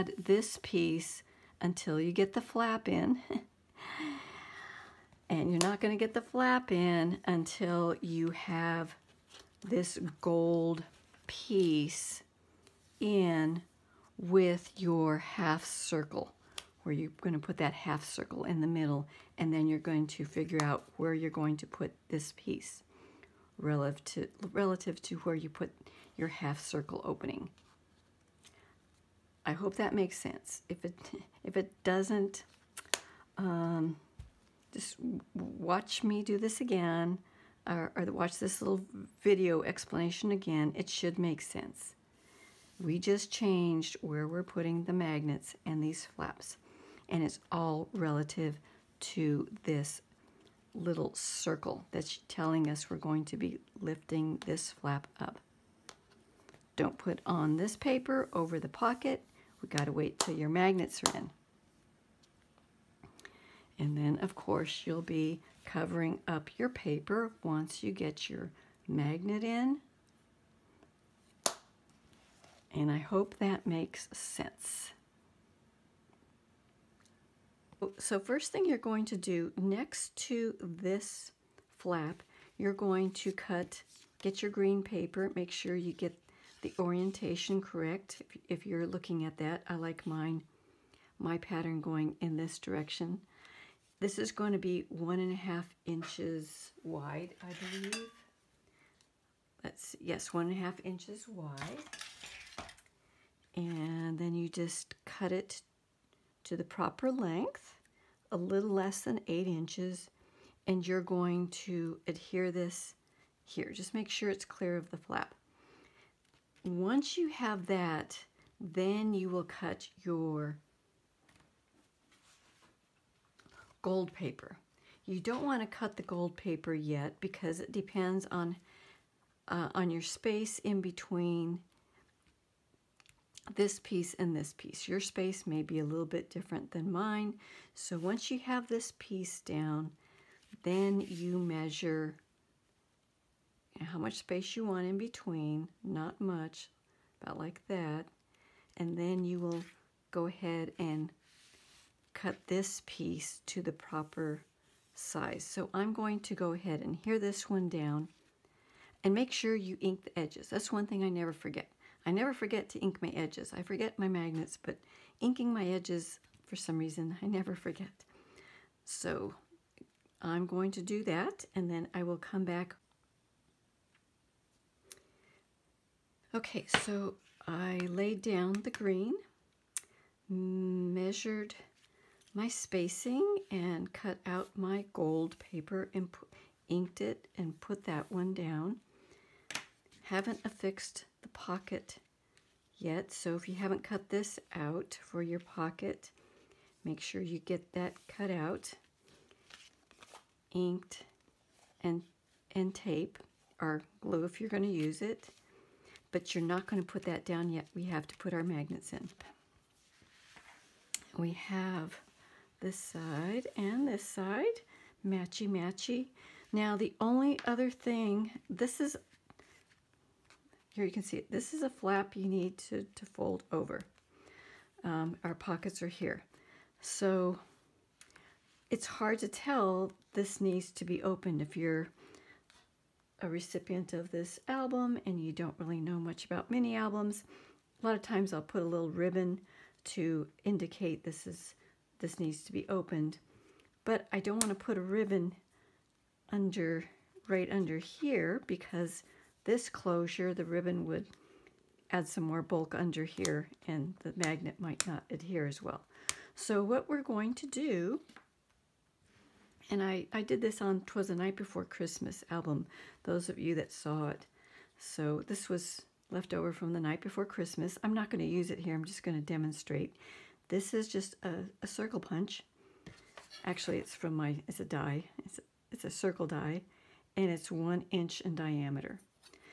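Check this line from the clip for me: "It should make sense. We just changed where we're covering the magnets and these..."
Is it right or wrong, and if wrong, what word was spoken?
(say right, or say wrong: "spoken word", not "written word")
wrong: "putting", not "covering".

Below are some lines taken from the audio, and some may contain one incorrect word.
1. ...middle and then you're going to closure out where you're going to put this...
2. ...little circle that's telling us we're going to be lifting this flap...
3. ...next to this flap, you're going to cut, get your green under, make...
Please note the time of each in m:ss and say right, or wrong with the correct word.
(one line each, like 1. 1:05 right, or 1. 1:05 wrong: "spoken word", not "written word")
1. 0:18 wrong: "figure", not "closure"
2. 0:50 right
3. 1:19 wrong: "paper", not "under".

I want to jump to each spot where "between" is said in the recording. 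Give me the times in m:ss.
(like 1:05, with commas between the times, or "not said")
2:10, 2:24.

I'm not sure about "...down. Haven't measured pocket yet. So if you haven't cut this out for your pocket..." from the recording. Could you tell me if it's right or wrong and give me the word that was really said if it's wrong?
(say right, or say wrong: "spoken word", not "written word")
wrong: "affixed", not "measured".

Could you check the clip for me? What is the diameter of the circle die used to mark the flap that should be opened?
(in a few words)
1 inch.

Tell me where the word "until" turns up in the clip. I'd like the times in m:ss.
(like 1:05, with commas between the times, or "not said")
0:01, 0:07.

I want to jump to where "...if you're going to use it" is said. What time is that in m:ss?
3:24.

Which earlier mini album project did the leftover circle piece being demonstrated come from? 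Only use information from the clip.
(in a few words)
Twas the Night Before Christmas.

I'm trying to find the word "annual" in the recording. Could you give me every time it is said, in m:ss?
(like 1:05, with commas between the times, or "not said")
not said.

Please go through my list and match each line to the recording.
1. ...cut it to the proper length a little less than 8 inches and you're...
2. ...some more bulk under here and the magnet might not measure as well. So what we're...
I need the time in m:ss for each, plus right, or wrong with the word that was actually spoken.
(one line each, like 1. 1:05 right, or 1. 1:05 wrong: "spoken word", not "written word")
1. 1:45 right
2. 4:12 wrong: "adhere", not "measure".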